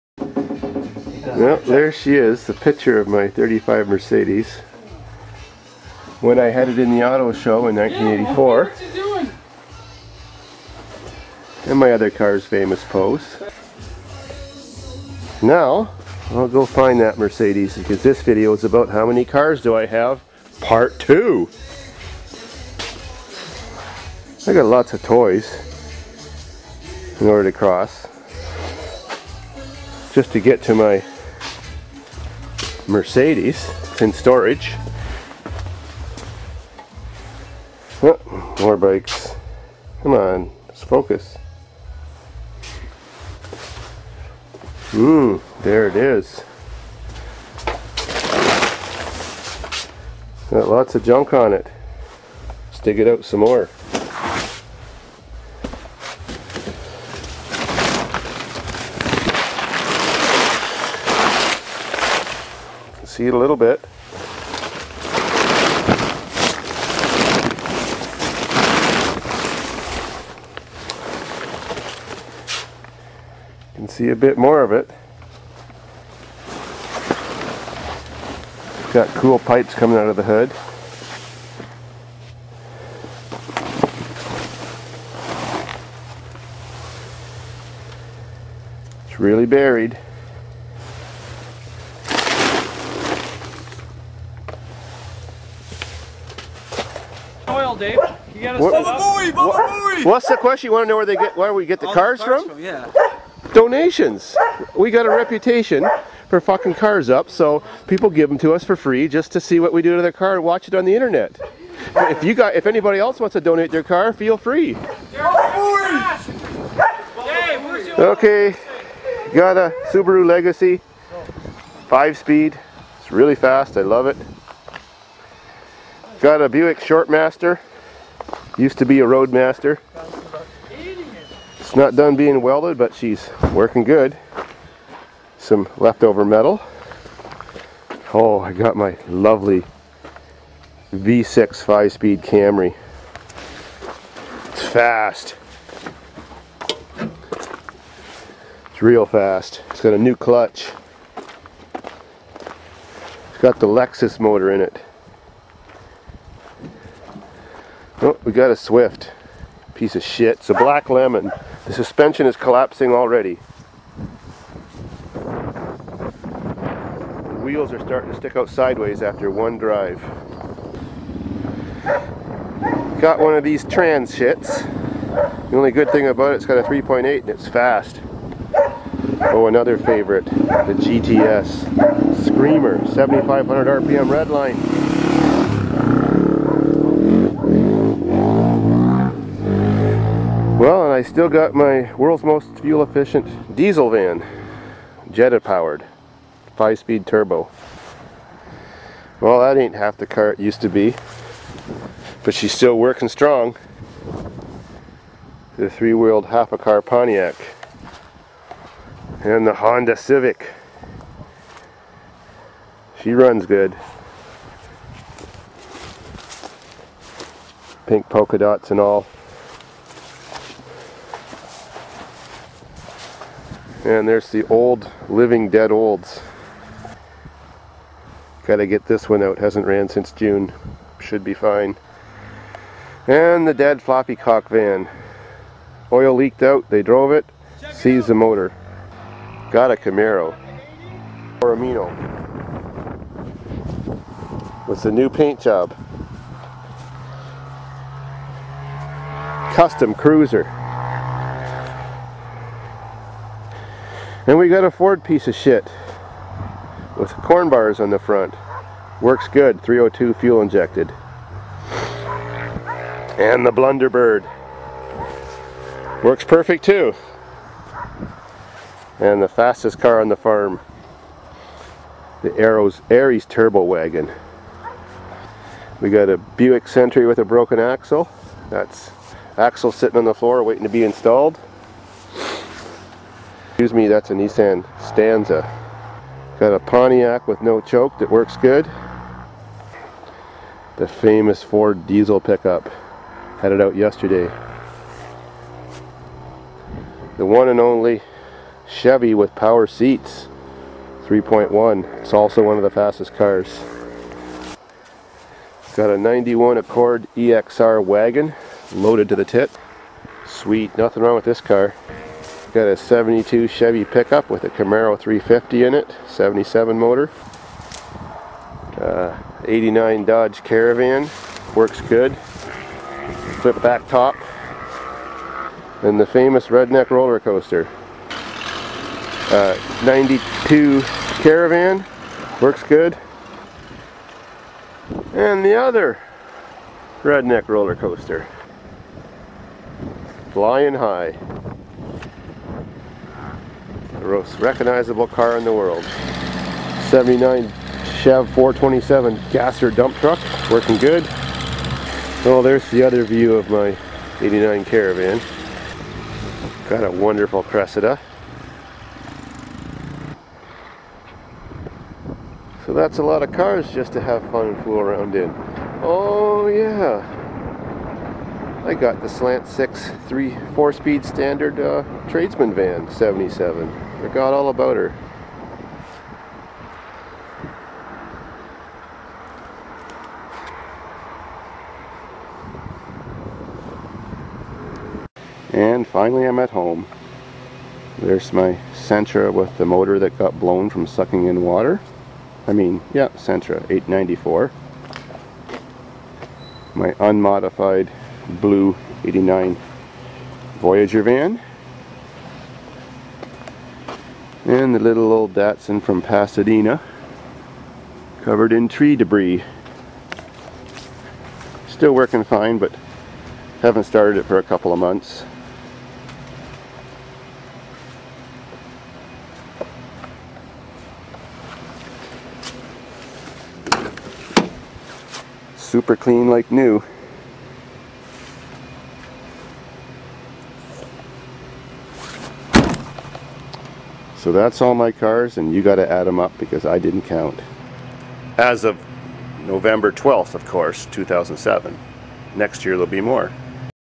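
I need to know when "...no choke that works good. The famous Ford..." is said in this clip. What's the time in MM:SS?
04:47.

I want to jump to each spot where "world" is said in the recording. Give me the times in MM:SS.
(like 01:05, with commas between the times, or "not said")
03:11, 05:45.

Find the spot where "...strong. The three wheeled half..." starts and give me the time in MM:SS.
03:23.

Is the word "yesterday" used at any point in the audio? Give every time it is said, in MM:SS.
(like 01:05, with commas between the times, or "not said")
04:53.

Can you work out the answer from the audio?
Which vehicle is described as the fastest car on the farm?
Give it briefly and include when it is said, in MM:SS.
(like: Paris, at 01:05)
Aries Turbo Wagon, at 04:32.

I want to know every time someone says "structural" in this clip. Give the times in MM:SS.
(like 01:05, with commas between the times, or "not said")
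not said.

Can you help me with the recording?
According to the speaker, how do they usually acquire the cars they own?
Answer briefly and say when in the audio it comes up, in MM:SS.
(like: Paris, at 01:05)
Donations, at 01:43.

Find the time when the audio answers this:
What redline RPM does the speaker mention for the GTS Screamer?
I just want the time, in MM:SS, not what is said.
03:02.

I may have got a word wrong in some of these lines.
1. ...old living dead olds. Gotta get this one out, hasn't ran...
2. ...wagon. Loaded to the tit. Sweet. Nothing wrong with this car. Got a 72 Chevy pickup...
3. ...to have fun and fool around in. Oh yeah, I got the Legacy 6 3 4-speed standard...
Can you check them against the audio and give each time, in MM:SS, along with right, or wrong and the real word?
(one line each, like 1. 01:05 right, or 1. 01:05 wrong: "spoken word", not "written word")
1. 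03:44 right
2. 05:07 right
3. 06:03 wrong: "Slant", not "Legacy".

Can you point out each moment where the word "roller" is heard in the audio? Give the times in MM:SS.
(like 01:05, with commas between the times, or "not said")
05:26, 05:37.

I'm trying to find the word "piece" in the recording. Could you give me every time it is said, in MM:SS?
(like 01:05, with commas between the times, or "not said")
02:39, 04:15.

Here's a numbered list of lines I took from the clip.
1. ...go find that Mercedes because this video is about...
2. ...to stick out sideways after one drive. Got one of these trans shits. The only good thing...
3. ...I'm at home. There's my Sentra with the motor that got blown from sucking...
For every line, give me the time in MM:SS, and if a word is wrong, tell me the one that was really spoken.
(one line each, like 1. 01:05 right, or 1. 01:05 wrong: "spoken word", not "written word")
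1. 00:16 right
2. 02:48 right
3. 06:26 right.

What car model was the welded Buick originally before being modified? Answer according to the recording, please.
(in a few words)
Roadmaster.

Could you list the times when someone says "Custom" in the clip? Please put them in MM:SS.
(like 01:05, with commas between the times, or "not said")
04:09.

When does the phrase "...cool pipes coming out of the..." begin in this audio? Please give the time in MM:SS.
01:19.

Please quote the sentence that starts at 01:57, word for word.
Okay, got a Subaru Legacy, five speed.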